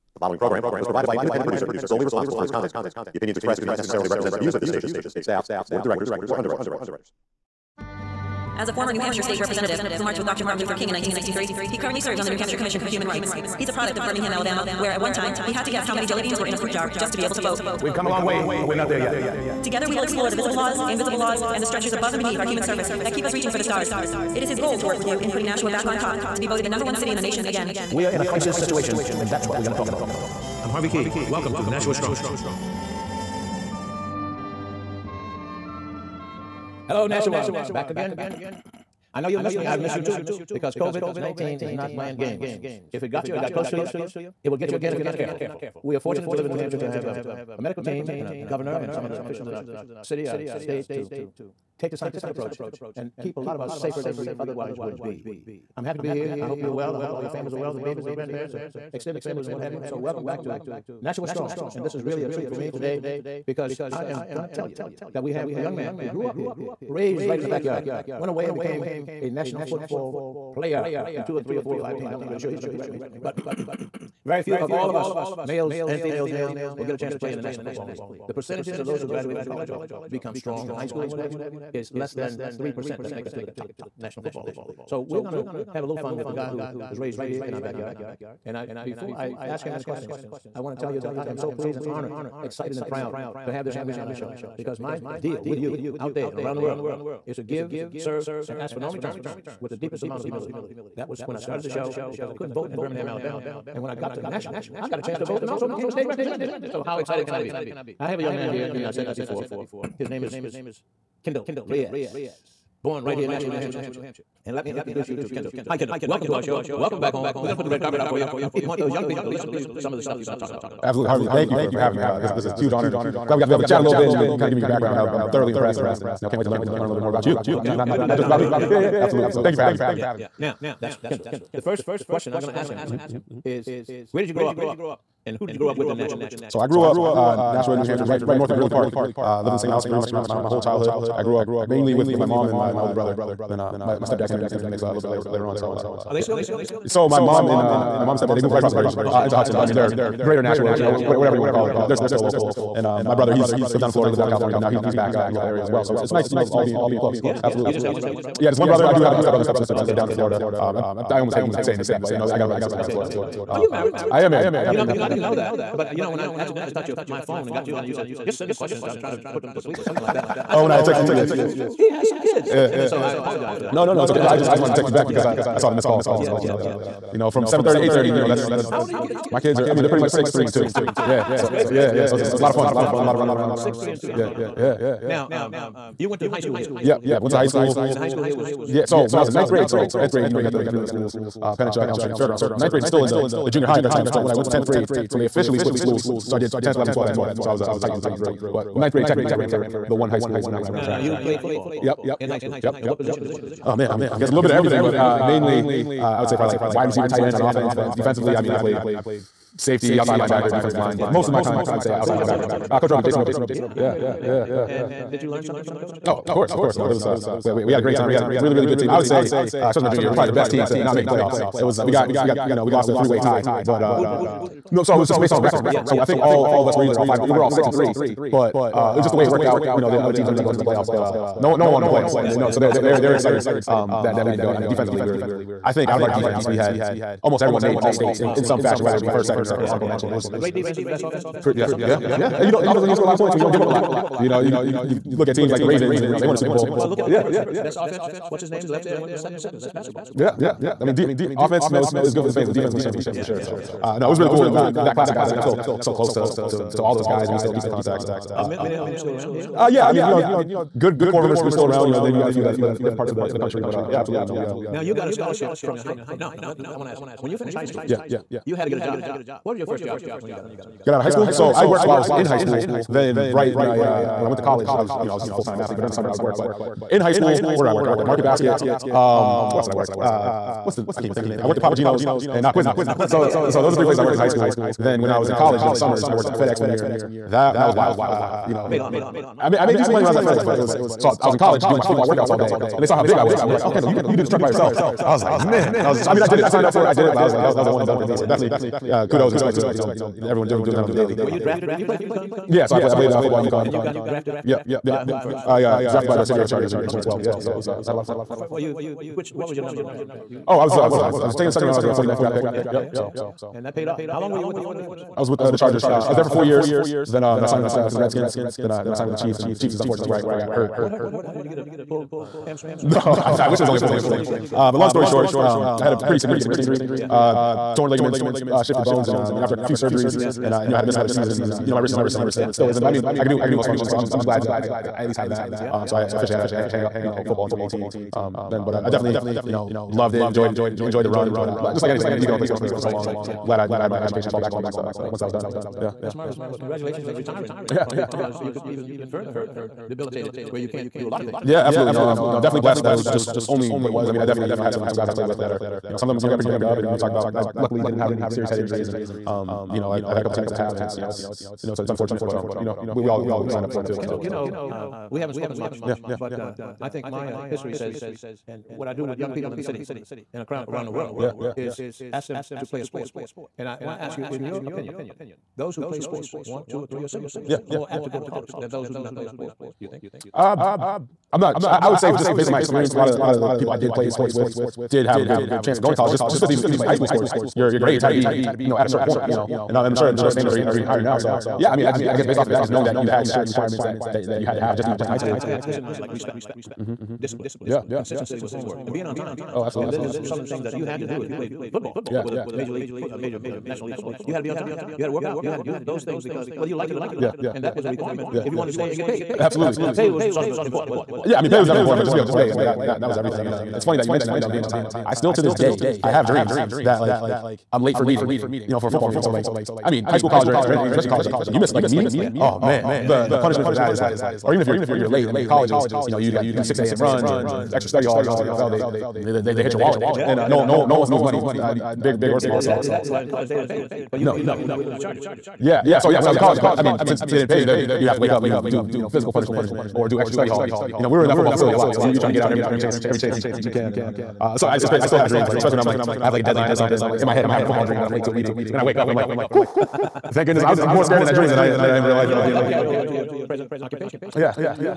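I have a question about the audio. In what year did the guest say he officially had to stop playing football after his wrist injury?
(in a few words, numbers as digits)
2018.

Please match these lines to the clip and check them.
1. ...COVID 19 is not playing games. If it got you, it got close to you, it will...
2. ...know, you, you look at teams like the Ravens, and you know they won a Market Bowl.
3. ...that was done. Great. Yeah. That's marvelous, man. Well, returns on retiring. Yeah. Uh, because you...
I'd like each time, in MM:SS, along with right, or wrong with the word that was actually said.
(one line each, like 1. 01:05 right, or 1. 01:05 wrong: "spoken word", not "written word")
1. 00:40 right
2. 04:04 wrong: "Super", not "Market"
3. 05:45 wrong: "congratulations", not "returns".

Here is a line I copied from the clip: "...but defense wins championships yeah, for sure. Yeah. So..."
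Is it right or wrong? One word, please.
right.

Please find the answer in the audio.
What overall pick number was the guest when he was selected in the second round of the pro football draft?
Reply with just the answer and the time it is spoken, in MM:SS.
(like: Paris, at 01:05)
49, at 05:11.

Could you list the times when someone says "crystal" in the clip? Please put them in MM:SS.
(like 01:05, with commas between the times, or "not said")
not said.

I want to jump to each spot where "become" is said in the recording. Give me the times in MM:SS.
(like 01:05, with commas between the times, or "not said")
01:20.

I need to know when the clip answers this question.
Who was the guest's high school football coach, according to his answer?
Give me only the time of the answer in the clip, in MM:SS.
03:33.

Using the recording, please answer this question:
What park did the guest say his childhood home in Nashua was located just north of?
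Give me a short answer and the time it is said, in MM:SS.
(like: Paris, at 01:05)
Greeley Park, at 02:18.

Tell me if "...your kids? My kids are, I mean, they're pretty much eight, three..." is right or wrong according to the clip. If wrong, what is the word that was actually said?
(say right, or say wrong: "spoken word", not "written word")
wrong: "six", not "eight".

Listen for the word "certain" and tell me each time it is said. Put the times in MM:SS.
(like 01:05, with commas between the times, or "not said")
06:28, 06:33.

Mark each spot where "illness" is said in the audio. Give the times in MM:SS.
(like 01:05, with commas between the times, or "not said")
not said.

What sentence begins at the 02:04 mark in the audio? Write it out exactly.
I'm, I'm thoroughly impressed, and uh, you know, can't wait to learn learn a little bit more about you.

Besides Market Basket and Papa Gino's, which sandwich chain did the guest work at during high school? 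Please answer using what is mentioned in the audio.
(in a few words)
Quiznos.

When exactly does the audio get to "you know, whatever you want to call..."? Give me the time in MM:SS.
02:30.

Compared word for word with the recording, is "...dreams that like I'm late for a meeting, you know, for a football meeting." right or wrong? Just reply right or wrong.
right.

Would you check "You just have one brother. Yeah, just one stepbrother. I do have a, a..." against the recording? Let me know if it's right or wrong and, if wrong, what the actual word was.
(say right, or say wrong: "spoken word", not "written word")
wrong: "brother", not "stepbrother".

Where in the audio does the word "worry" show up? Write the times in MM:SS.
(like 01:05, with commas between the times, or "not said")
not said.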